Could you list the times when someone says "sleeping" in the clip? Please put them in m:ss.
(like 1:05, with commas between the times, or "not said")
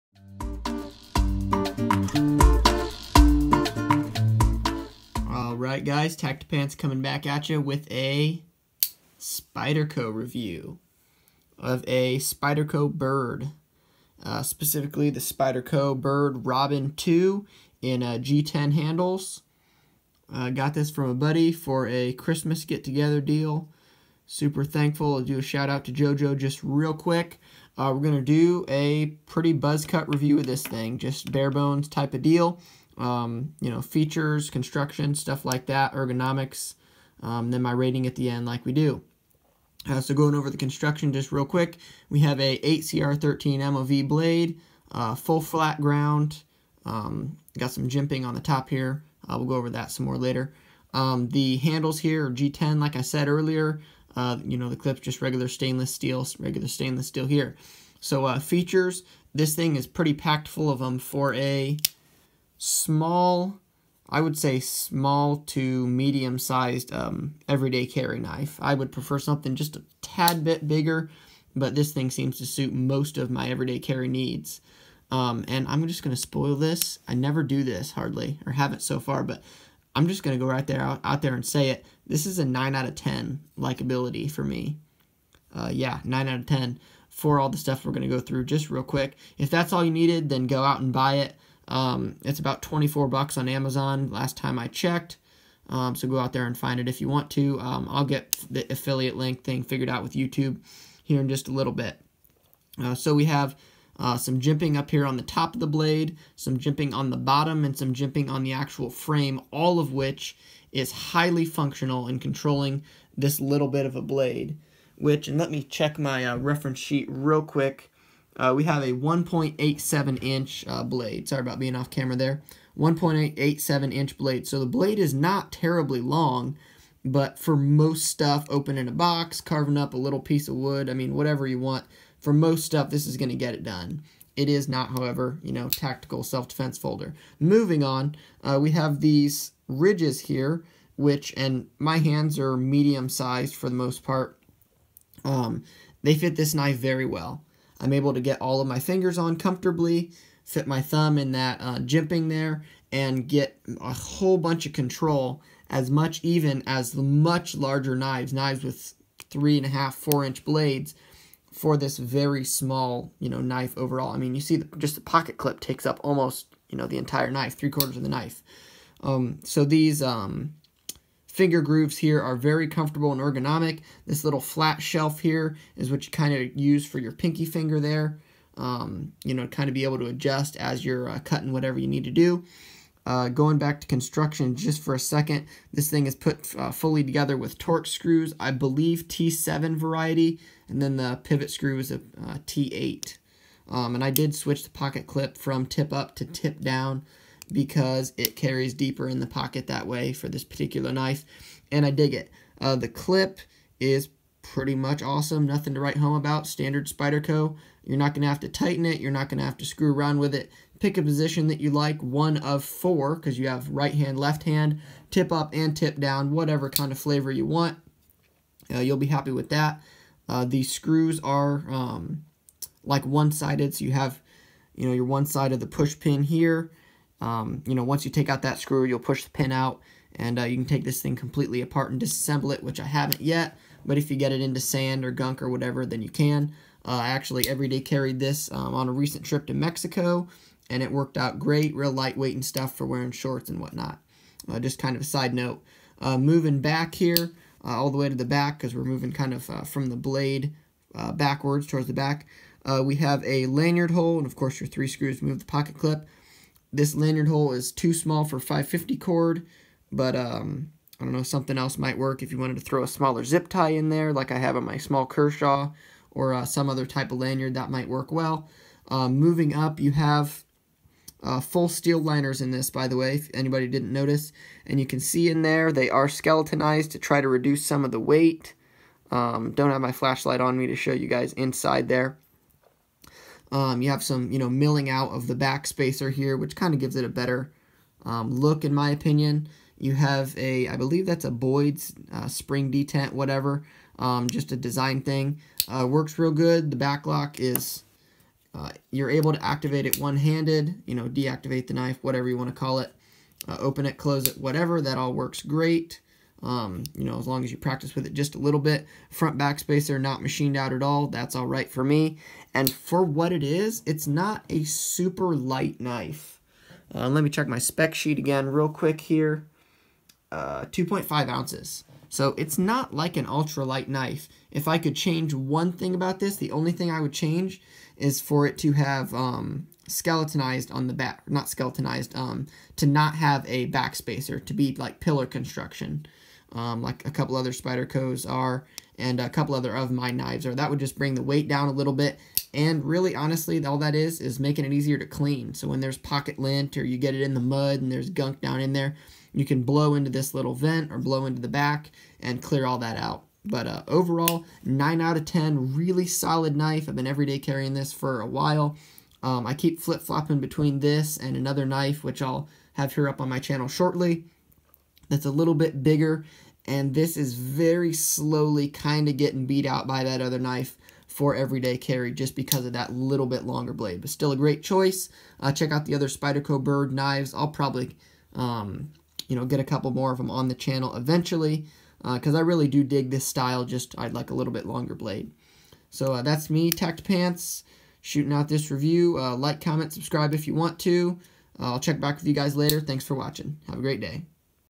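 not said.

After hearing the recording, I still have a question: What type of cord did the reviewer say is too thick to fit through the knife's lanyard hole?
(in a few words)
550 cord.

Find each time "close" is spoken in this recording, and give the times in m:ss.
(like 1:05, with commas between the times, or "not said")
5:03.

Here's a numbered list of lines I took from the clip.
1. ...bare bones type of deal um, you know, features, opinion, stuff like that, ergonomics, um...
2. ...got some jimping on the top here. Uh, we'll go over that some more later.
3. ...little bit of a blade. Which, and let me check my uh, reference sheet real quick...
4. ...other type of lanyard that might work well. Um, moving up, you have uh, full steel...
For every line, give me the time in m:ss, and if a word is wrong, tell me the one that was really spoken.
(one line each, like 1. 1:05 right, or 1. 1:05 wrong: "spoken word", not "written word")
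1. 0:31 wrong: "construction", not "opinion"
2. 0:47 right
3. 1:53 right
4. 4:26 right.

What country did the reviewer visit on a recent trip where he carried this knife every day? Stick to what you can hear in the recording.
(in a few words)
Mexico.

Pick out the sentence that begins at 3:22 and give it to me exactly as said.
Uh, the clip is pretty much awesome, nothing to write home about, standard Spyderco.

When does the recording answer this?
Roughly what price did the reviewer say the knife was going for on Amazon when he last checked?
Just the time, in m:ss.
1:32.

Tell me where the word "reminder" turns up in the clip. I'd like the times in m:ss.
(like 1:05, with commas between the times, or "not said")
not said.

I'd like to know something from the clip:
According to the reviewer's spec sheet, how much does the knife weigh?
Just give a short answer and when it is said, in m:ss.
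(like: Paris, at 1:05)
2.5 ounces, at 5:20.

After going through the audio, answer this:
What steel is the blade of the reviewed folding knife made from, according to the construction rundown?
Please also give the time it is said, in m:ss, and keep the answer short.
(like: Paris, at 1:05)
8CR13 MOV, at 0:42.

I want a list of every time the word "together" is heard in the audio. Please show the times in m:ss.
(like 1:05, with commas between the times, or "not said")
0:22, 3:07.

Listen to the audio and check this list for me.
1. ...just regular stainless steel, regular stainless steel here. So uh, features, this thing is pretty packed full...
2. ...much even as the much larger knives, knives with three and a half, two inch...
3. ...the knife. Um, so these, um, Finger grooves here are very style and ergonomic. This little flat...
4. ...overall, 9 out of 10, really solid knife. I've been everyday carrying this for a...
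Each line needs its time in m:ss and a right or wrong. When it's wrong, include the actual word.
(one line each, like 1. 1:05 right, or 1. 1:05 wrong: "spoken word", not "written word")
1. 0:54 right
2. 2:35 wrong: "four", not "two"
3. 2:48 wrong: "comfortable", not "style"
4. 5:53 right.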